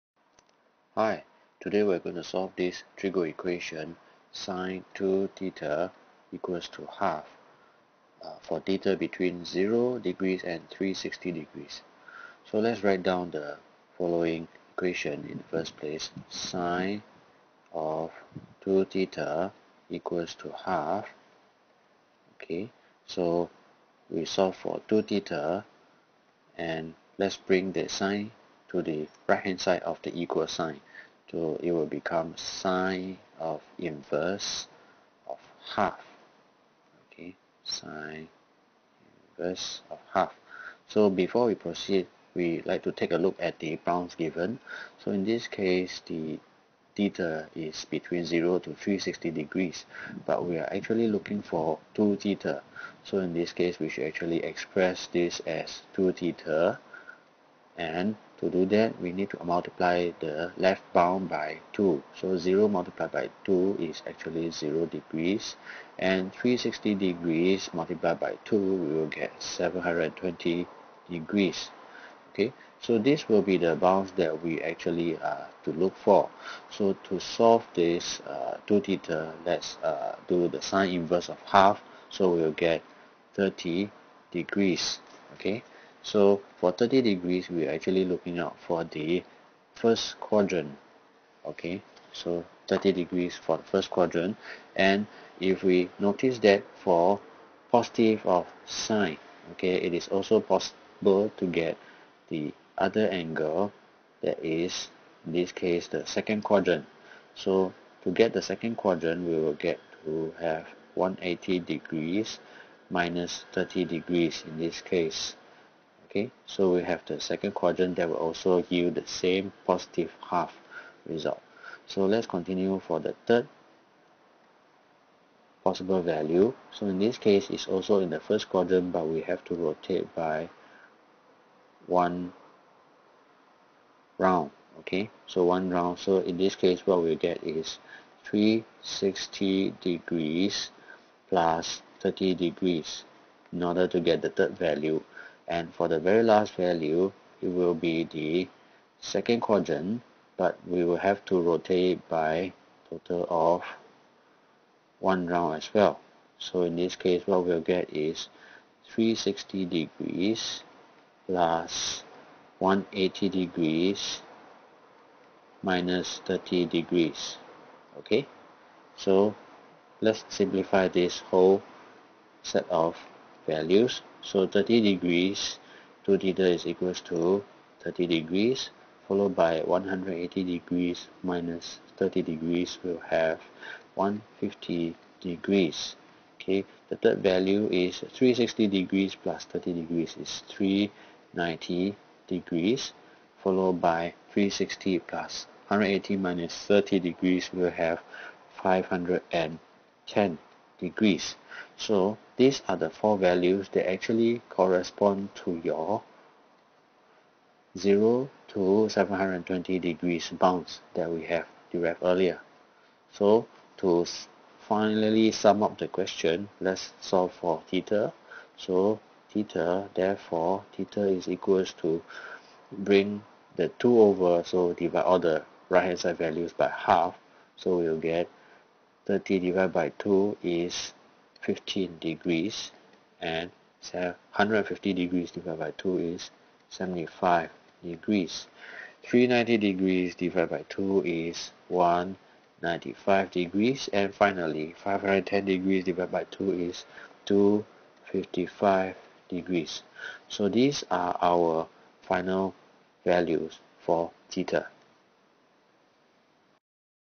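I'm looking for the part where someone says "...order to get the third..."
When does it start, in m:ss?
2:23.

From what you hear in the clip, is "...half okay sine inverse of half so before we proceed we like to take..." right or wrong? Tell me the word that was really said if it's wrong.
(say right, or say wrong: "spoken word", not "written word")
right.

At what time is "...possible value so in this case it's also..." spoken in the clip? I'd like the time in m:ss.
2:05.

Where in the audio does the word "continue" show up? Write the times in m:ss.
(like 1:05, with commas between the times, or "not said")
2:02.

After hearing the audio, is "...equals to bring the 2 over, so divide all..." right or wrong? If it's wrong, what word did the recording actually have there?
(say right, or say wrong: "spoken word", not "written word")
right.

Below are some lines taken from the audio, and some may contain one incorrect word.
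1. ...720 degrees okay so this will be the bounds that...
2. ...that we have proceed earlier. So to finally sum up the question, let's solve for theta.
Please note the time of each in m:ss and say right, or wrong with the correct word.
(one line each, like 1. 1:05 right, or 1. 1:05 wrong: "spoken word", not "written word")
1. 1:09 right
2. 3:30 wrong: "derived", not "proceed".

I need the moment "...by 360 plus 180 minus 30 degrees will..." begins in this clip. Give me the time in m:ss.
3:13.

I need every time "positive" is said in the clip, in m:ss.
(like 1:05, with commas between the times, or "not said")
1:37, 1:59.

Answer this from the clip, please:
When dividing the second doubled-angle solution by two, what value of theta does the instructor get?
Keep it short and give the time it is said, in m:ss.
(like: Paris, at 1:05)
75 degrees, at 3:56.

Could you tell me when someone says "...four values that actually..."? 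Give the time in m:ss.
3:22.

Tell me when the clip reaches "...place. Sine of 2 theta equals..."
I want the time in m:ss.
0:15.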